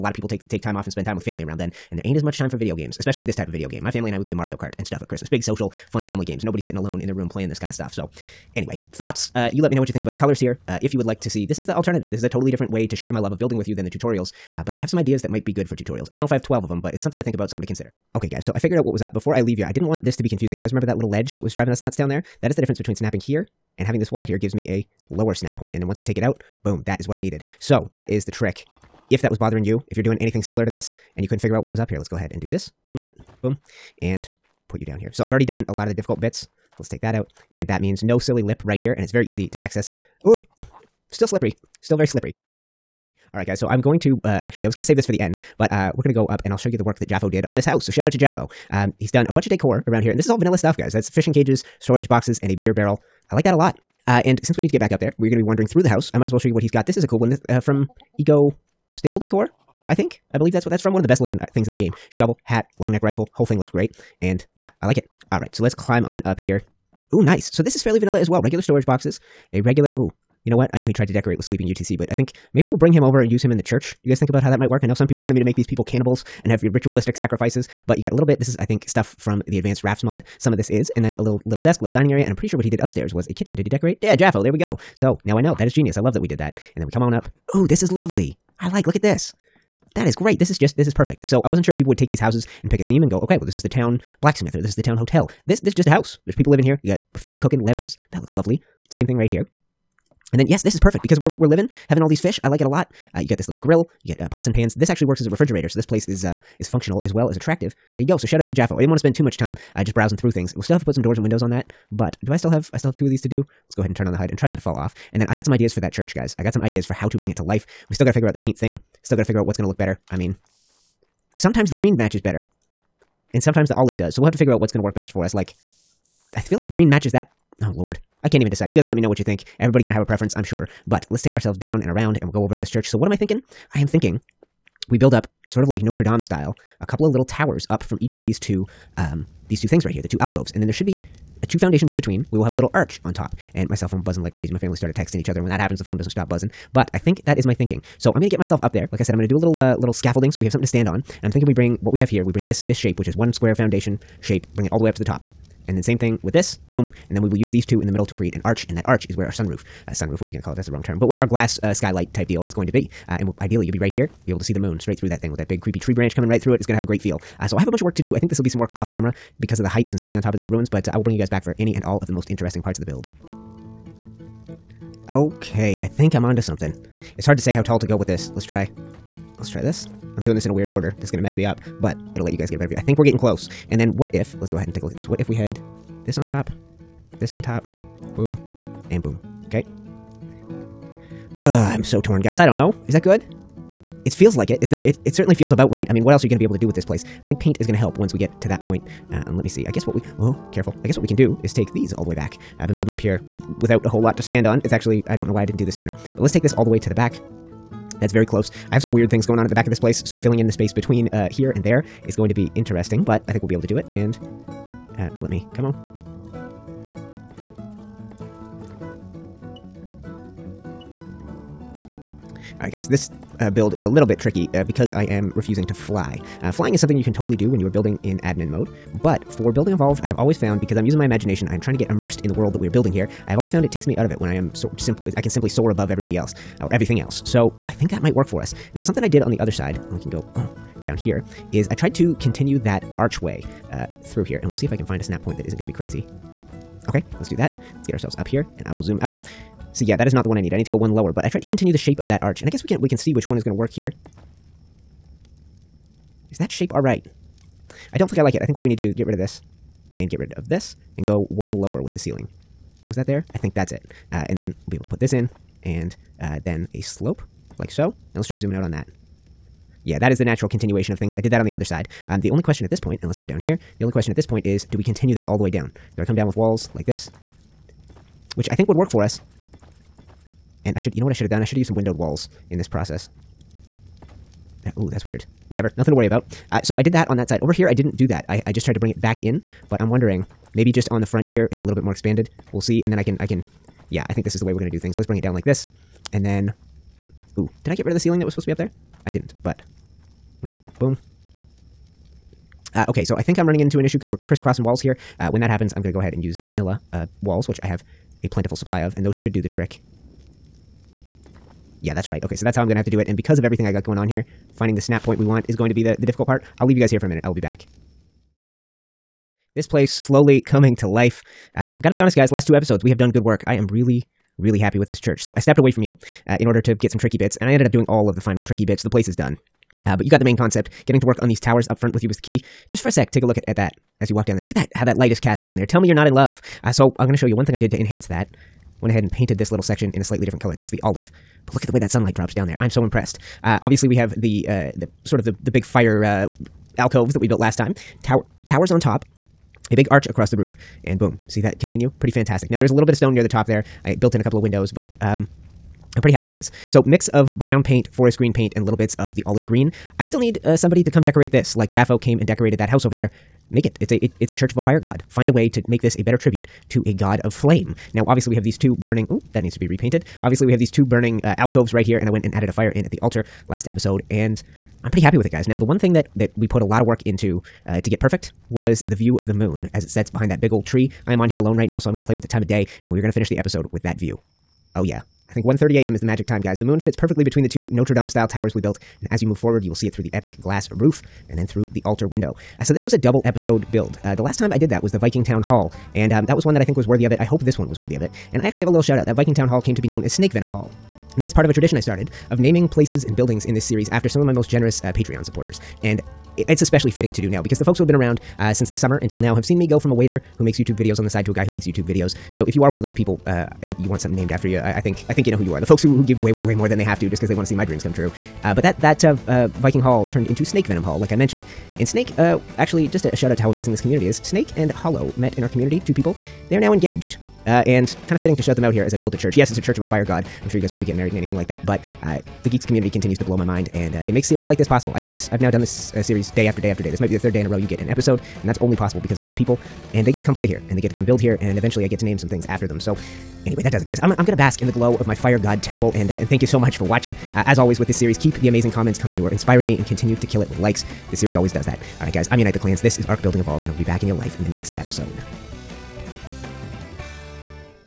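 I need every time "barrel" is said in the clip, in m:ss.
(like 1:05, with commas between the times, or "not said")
0:52.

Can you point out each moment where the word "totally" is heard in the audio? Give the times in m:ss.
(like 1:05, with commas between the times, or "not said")
0:12, 3:47.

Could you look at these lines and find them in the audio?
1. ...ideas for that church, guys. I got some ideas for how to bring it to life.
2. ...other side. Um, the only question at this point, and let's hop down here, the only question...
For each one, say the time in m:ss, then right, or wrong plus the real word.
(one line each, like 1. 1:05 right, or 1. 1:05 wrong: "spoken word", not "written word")
1. 1:55 right
2. 4:31 right.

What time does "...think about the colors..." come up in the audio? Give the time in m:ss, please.
0:09.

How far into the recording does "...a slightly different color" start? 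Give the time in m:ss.
5:40.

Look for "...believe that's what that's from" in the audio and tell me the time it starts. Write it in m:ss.
1:00.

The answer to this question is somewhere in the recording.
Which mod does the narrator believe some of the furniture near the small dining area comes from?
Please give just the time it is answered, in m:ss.
1:19.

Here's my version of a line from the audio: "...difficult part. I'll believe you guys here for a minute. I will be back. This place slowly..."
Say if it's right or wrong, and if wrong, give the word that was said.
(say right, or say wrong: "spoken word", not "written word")
wrong: "leave", not "believe".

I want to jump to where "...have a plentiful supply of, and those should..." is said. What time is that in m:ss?
5:07.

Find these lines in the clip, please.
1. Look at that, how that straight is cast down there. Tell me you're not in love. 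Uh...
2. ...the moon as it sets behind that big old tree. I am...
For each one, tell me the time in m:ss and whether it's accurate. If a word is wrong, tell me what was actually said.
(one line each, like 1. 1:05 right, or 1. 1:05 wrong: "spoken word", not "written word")
1. 5:34 wrong: "light", not "straight"
2. 6:19 right.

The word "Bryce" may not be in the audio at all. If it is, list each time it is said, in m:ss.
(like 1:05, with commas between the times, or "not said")
not said.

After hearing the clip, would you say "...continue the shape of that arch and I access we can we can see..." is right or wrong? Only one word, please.
wrong.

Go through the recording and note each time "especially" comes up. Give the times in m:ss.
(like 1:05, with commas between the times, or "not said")
0:02, 6:46.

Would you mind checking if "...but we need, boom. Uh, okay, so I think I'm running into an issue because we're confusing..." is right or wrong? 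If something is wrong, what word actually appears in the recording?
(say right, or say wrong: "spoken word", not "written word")
wrong: "crisscrossing", not "confusing".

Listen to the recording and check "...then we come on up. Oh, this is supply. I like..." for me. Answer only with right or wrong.
wrong.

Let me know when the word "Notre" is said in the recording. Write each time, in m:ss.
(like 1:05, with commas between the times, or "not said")
2:15, 6:27.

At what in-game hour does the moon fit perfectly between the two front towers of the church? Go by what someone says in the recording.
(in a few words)
1:30 a.m.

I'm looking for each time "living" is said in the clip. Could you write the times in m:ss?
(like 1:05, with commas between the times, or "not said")
1:36, 1:41.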